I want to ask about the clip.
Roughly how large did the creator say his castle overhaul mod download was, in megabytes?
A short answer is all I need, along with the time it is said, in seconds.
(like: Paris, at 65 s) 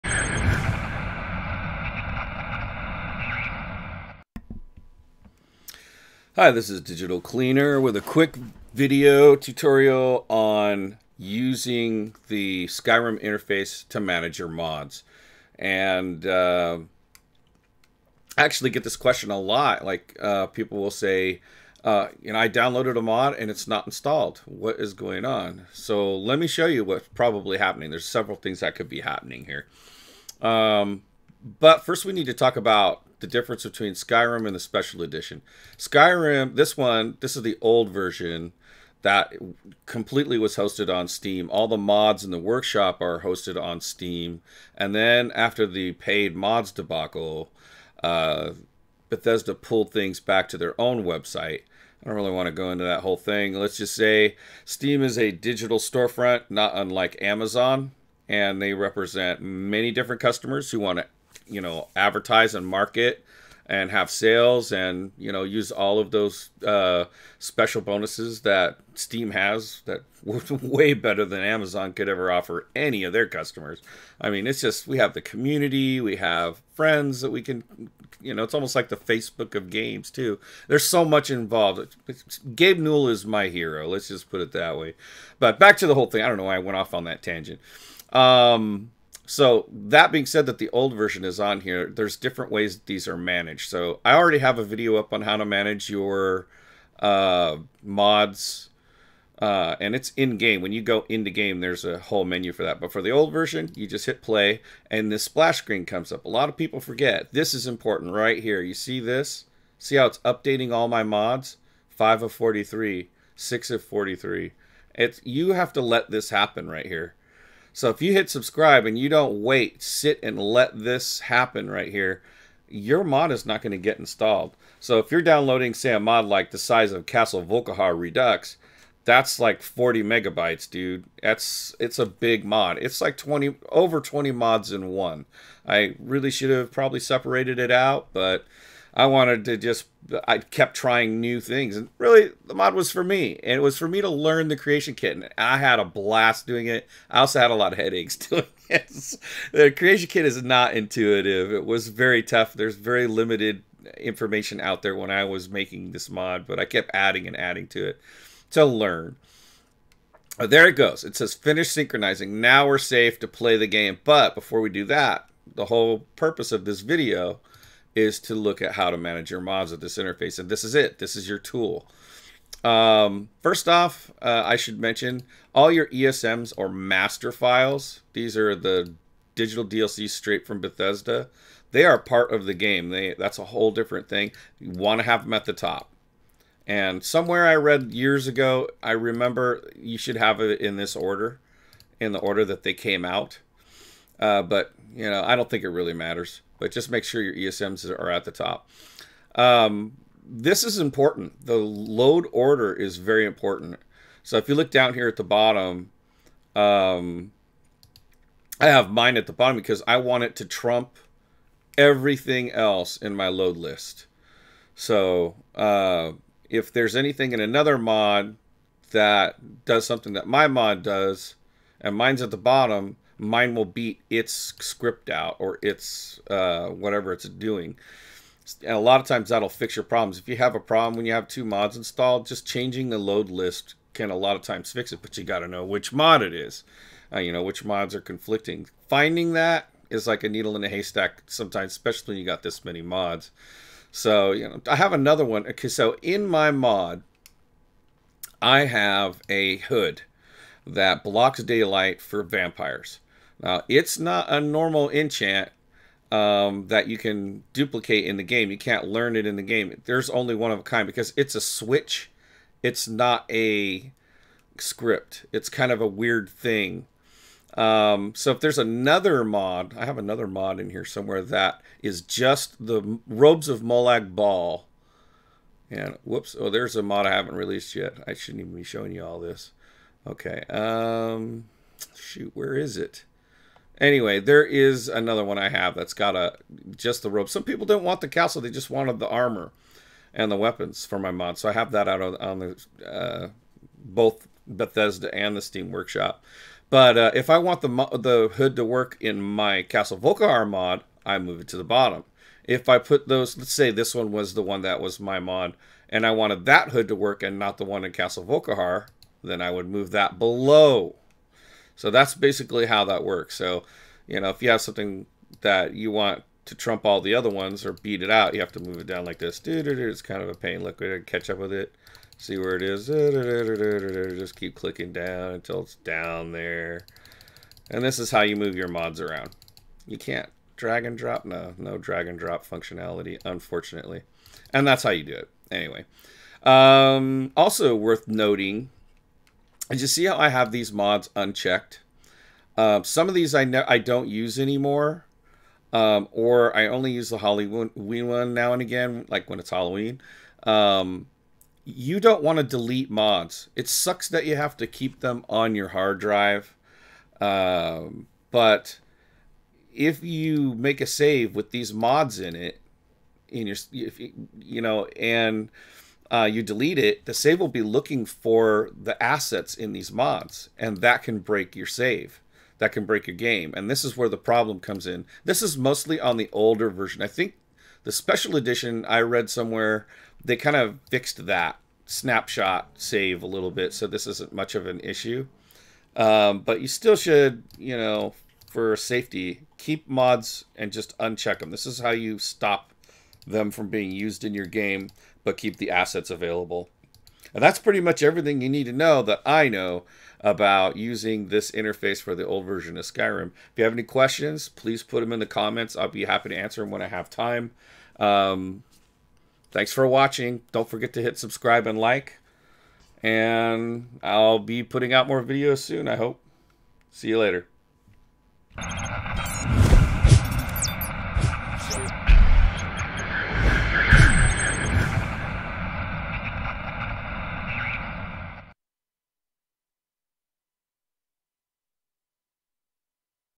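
40 megabytes, at 129 s.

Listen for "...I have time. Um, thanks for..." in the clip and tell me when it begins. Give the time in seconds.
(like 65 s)
406 s.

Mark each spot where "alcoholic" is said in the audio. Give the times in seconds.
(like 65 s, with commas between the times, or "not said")
not said.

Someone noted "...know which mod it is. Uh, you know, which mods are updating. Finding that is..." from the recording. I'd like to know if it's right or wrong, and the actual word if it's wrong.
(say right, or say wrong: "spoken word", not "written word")
wrong: "conflicting", not "updating".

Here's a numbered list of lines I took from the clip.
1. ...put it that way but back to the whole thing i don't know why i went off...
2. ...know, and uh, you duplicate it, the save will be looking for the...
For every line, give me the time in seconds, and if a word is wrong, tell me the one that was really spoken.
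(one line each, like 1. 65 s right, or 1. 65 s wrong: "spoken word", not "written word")
1. 84 s right
2. 364 s wrong: "delete", not "duplicate".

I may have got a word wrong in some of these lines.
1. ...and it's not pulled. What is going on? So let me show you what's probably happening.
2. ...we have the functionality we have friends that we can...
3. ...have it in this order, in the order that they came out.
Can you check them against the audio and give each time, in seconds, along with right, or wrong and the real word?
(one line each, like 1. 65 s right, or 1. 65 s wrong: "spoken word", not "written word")
1. 23 s wrong: "installed", not "pulled"
2. 74 s wrong: "community", not "functionality"
3. 190 s right.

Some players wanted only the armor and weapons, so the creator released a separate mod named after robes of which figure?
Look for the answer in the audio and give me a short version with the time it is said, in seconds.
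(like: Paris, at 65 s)
Molag Bal, at 273 s.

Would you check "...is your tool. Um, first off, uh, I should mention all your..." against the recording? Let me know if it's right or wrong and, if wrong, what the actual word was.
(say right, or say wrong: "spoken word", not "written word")
right.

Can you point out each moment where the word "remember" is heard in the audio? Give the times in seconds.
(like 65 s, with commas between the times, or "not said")
188 s.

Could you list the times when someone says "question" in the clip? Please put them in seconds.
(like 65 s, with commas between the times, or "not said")
18 s, 403 s.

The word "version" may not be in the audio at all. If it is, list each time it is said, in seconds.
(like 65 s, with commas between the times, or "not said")
37 s, 90 s, 103 s, 376 s, 402 s.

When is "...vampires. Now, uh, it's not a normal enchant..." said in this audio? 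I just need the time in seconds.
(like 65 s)
252 s.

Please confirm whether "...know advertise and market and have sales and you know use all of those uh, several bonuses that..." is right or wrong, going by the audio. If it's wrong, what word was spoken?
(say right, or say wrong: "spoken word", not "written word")
wrong: "special", not "several".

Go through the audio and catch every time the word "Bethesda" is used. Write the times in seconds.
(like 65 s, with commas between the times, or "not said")
49 s, 180 s, 294 s.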